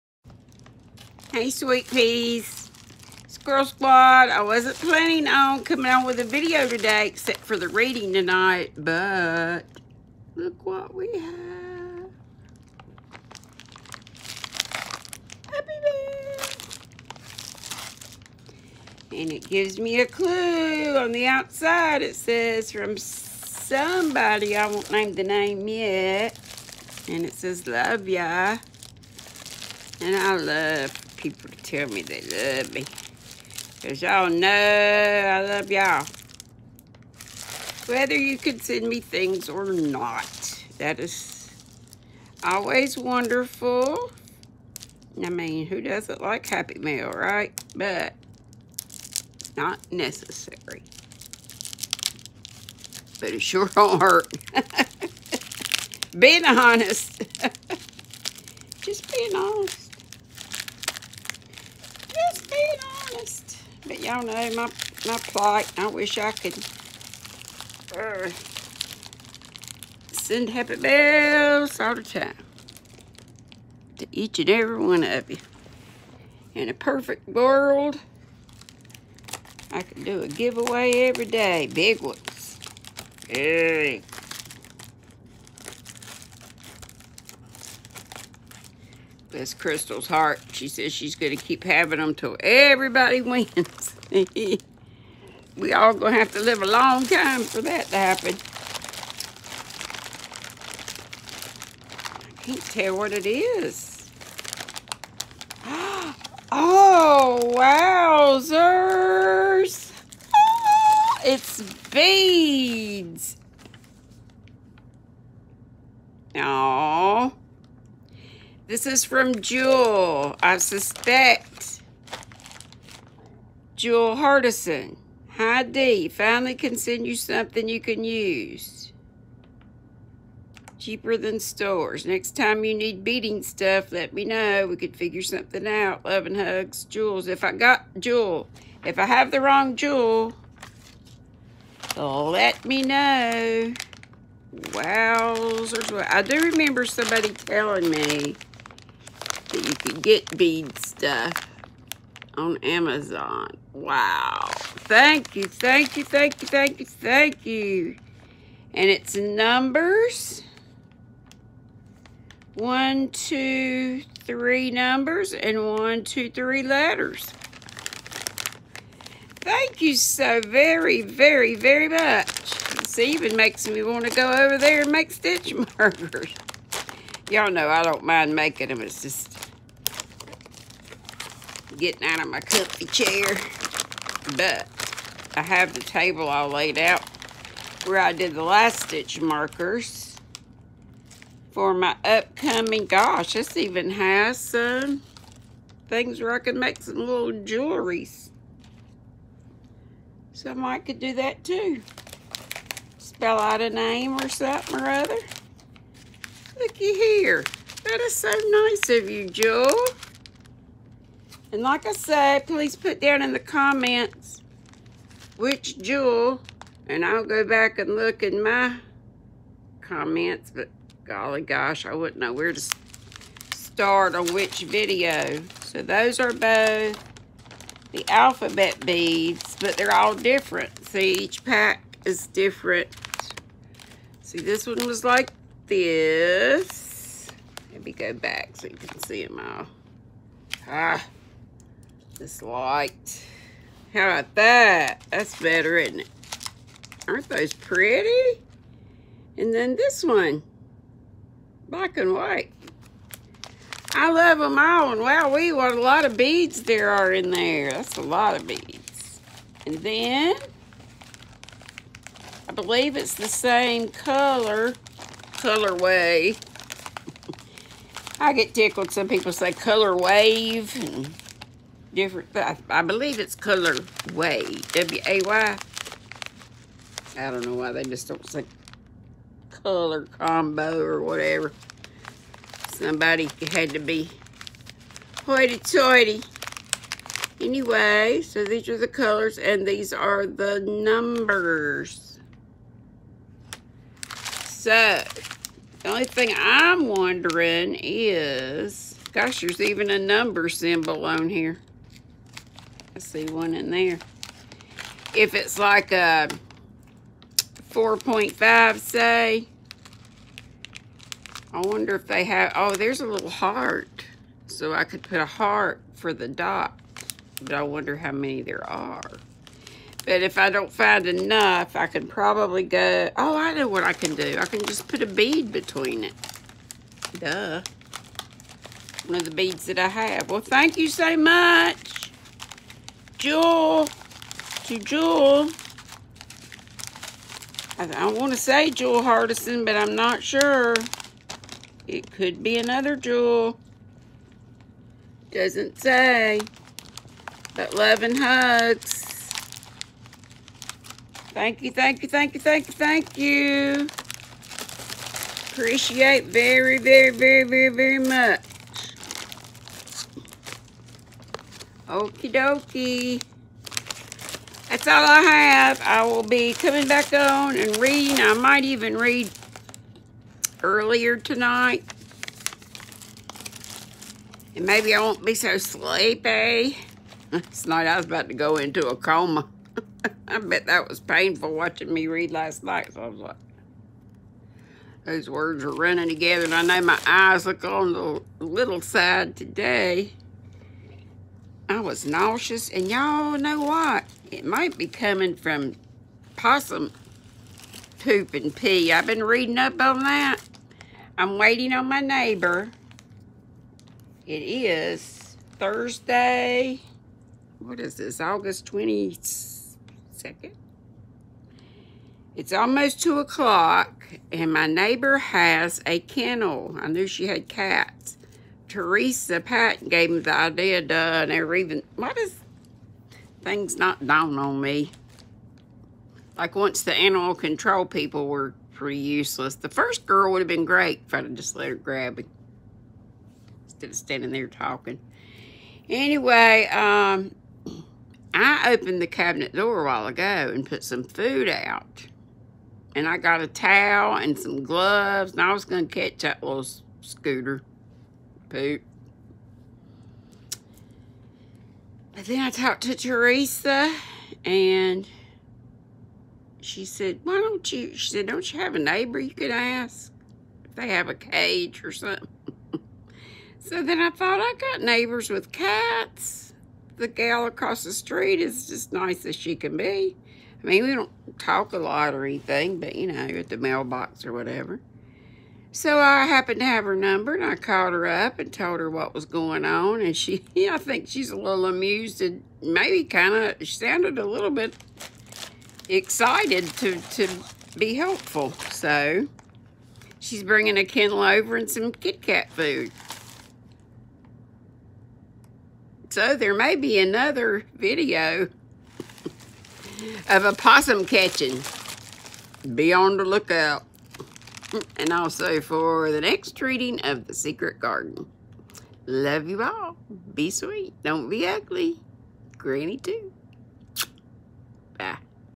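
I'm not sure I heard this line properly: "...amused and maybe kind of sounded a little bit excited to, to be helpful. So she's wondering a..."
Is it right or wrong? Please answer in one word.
wrong.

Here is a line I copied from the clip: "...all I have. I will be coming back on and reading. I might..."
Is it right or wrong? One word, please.
right.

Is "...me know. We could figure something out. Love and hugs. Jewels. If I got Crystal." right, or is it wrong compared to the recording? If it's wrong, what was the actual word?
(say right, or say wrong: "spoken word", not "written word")
wrong: "Jewel", not "Crystal".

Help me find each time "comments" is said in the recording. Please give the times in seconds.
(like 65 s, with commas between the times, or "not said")
213 s, 219 s.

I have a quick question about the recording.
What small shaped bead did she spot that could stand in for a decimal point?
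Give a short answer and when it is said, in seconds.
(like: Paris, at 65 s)
A heart, at 313 s.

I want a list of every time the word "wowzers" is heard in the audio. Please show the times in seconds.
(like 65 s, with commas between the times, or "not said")
107 s, 144 s.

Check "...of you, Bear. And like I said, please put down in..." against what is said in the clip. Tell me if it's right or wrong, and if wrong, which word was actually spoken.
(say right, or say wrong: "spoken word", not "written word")
wrong: "Jewel", not "Bear".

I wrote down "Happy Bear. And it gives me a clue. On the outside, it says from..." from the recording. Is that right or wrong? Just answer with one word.
right.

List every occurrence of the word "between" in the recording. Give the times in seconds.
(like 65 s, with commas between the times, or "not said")
325 s.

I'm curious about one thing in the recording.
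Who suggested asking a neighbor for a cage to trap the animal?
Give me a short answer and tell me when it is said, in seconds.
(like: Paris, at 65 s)
Teresa Patton, at 418 s.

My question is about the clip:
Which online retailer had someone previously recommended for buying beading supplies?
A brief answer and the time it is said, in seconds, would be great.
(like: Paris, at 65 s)
Amazon, at 152 s.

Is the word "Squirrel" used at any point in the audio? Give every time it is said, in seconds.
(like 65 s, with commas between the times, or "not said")
3 s.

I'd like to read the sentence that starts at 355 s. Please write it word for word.
Appreciate very, very, very, very, very much.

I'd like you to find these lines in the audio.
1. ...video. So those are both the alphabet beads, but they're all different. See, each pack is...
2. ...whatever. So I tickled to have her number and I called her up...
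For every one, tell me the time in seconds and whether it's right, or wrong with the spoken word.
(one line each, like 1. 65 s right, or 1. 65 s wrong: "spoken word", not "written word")
1. 224 s right
2. 474 s wrong: "happened", not "tickled".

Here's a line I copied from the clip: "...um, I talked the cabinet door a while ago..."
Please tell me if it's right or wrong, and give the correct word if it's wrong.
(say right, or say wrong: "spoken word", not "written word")
wrong: "opened", not "talked".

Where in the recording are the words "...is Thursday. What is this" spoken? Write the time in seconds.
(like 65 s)
404 s.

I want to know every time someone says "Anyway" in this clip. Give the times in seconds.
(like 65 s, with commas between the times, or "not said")
287 s, 435 s.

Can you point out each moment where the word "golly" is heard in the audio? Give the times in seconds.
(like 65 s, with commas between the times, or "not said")
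221 s.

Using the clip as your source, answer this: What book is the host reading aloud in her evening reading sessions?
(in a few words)
The Secret Garden.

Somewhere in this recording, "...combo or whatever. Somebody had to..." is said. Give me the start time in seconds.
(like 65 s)
280 s.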